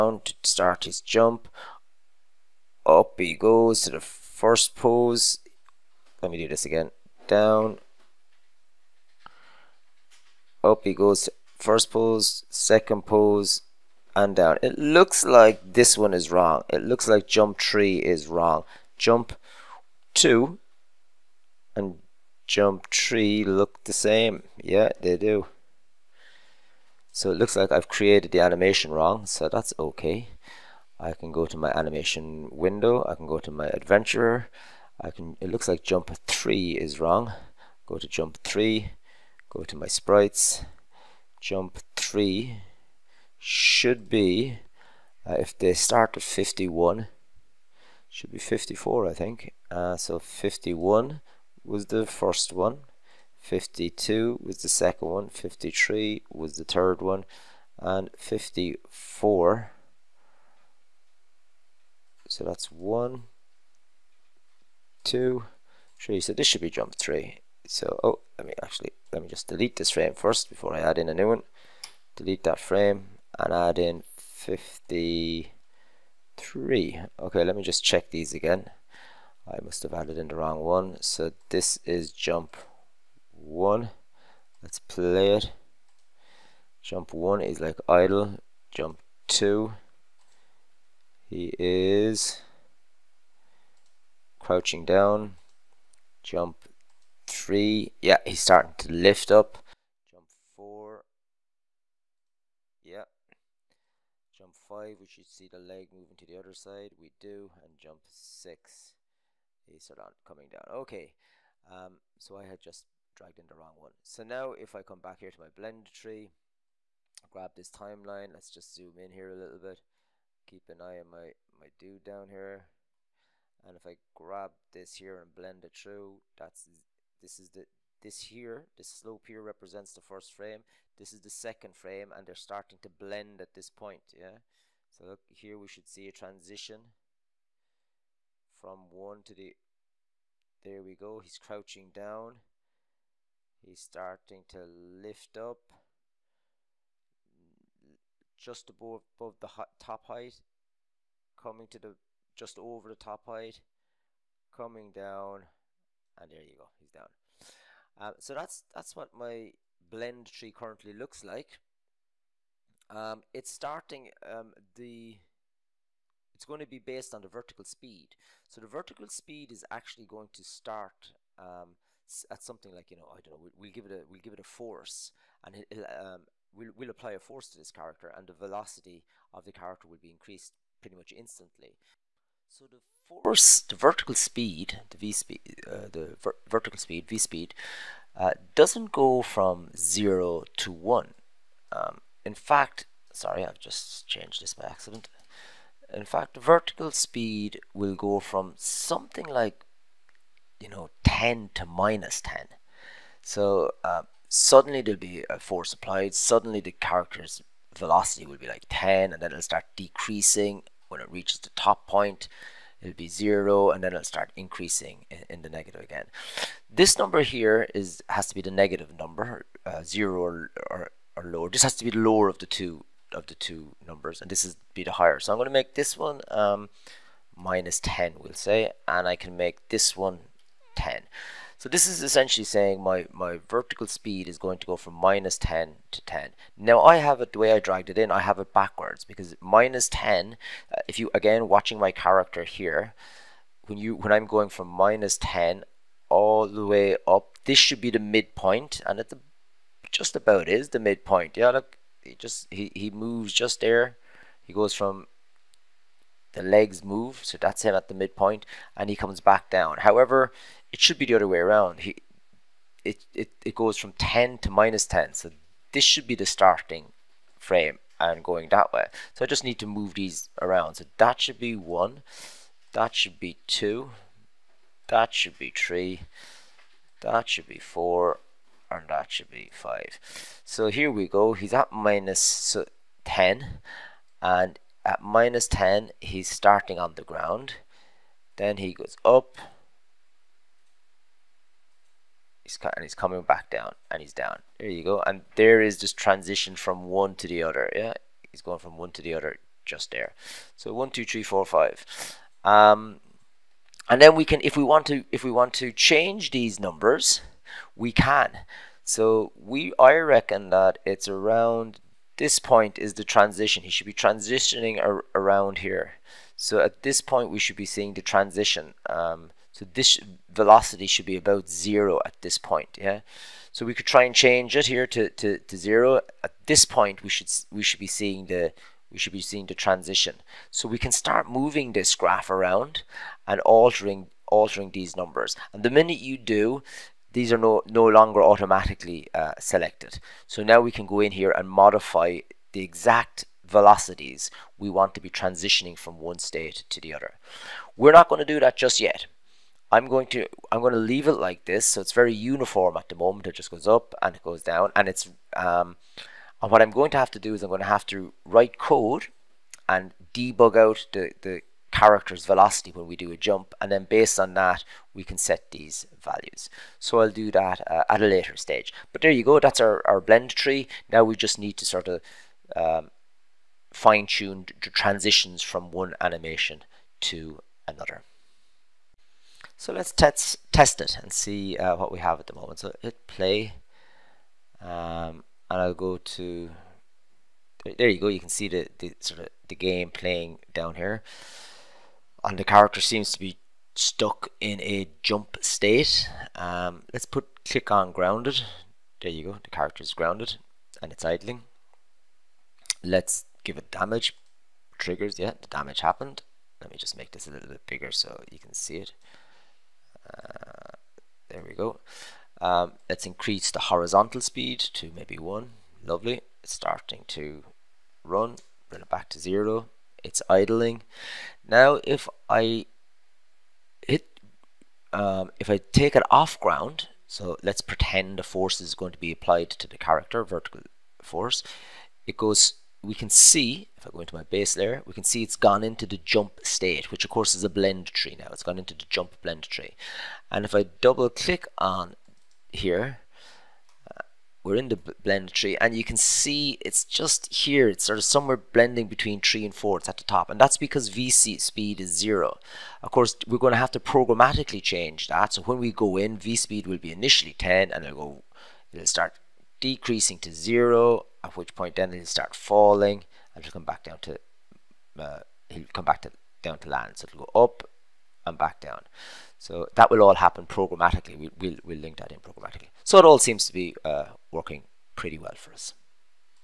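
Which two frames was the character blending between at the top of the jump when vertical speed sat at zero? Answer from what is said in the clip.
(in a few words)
3 and 4.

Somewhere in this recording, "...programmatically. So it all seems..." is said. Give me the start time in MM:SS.
07:52.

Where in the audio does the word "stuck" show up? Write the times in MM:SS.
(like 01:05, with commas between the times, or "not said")
06:33.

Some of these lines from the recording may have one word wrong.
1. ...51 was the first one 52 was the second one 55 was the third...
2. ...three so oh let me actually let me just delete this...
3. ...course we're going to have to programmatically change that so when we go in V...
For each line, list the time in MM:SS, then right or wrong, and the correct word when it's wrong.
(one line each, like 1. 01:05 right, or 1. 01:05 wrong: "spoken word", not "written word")
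1. 00:50 wrong: "53", not "55"
2. 01:06 right
3. 07:32 right.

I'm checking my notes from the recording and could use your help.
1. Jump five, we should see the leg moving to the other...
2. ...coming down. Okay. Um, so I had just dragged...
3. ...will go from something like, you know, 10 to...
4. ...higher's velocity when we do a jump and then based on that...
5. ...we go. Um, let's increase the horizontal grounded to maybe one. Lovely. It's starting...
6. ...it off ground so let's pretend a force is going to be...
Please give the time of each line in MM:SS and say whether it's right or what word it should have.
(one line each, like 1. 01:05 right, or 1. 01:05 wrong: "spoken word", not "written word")
1. 01:44 right
2. 01:50 right
3. 03:17 right
4. 06:01 wrong: "character", not "higher"
5. 06:51 wrong: "speed", not "grounded"
6. 07:05 right.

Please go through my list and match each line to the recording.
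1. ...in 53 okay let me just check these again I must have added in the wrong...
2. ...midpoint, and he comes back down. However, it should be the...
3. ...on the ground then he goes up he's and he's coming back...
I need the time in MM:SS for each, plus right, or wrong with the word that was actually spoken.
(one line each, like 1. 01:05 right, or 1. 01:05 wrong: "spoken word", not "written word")
1. 01:13 right
2. 04:17 right
3. 04:46 right.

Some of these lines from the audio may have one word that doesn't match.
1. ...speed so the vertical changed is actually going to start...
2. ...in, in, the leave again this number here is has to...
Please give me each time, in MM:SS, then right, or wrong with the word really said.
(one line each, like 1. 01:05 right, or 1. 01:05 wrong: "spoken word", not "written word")
1. 02:47 wrong: "speed", not "changed"
2. 03:35 wrong: "negative", not "leave".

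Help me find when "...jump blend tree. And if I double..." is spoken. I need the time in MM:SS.
07:18.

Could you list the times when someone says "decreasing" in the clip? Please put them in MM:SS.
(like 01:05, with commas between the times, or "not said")
03:29, 07:39.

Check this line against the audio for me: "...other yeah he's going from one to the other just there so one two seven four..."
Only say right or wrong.
wrong.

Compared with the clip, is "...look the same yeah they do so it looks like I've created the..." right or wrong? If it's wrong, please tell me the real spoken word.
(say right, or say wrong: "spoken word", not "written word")
right.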